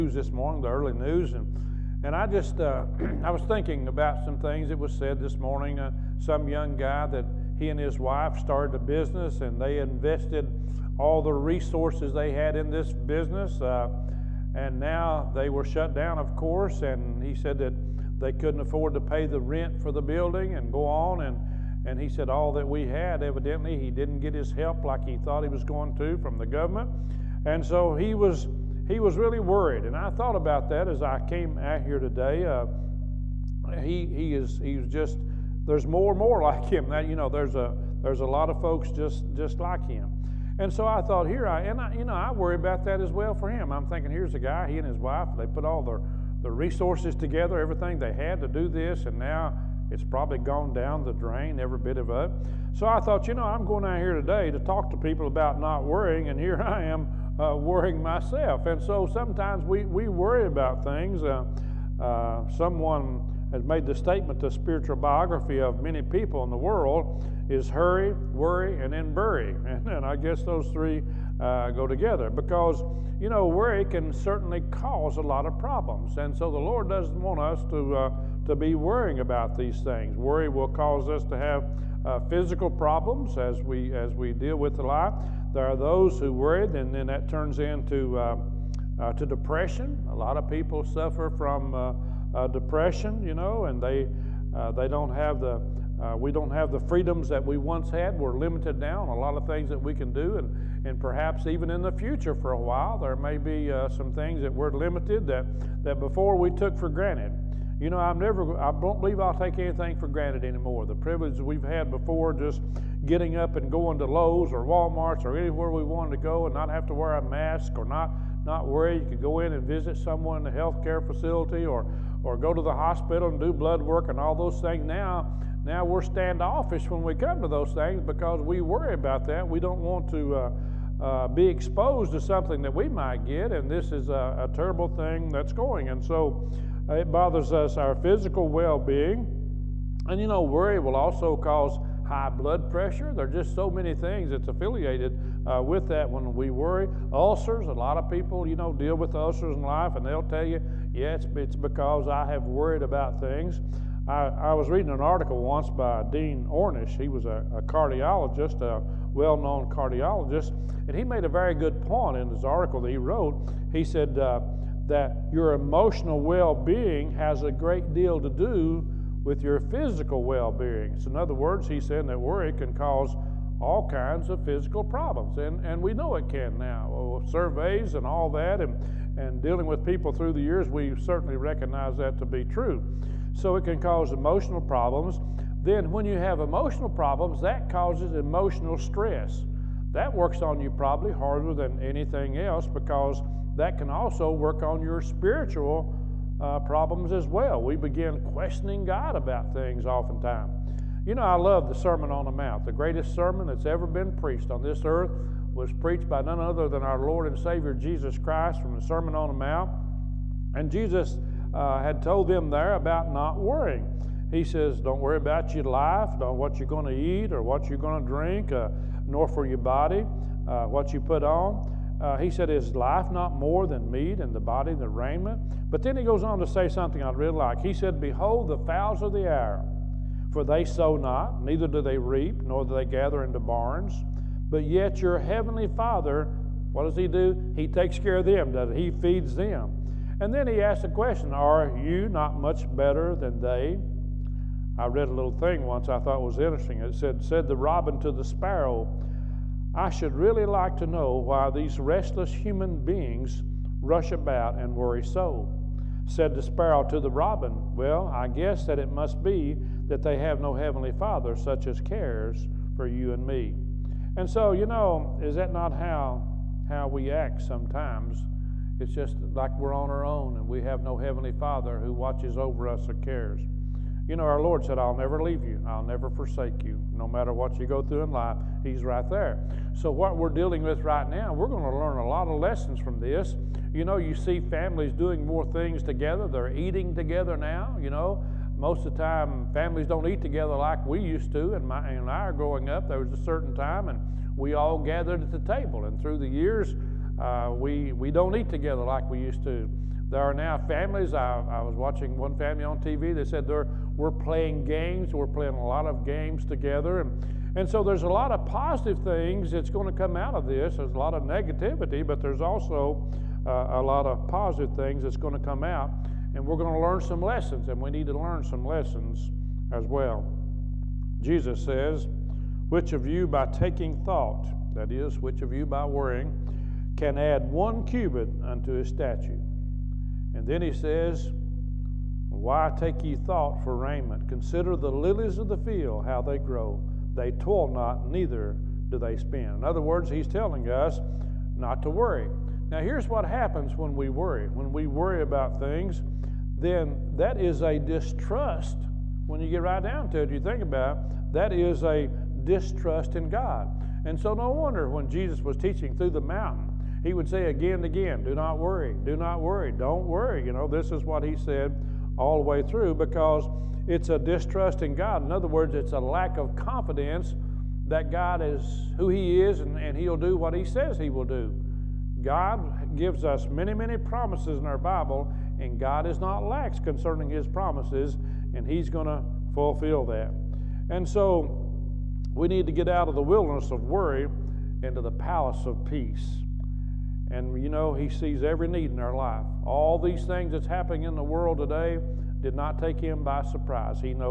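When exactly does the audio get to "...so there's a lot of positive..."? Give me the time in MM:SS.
05:07.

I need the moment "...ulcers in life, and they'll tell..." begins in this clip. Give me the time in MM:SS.
02:29.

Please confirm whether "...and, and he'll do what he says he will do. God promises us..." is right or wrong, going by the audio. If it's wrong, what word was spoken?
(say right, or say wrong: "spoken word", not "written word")
wrong: "gives", not "promises".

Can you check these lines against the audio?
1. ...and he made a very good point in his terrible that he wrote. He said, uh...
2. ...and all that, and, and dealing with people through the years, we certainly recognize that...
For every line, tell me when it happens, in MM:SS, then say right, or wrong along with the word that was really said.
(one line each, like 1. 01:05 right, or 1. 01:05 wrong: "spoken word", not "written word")
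1. 02:40 wrong: "article", not "terrible"
2. 02:57 right.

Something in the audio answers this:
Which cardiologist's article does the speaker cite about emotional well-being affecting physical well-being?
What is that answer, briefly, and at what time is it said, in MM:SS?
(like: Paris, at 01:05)
Dean Ornish, at 02:36.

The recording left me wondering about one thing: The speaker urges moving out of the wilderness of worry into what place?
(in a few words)
The palace of peace.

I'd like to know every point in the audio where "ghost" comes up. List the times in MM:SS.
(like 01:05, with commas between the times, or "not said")
not said.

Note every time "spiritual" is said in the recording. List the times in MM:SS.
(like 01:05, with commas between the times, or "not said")
01:04, 03:15.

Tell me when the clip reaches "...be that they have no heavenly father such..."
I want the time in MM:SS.
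04:19.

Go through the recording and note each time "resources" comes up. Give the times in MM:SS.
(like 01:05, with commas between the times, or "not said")
00:11, 00:46.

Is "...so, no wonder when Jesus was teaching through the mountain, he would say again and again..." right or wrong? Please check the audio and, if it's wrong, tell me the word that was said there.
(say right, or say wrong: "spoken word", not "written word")
right.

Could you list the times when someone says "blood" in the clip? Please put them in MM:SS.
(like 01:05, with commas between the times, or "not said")
02:03, 02:22.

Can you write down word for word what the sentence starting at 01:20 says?
Worry will cause us to have uh, physical problems as we, as we deal with the life.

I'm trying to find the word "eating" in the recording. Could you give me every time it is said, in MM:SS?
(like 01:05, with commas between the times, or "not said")
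04:46.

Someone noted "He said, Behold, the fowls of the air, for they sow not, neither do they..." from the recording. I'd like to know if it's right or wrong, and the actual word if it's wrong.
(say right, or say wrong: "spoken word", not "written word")
right.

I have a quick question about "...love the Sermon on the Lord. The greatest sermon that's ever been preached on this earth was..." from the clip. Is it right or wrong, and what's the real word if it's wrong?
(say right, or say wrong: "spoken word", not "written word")
wrong: "Mount", not "Lord".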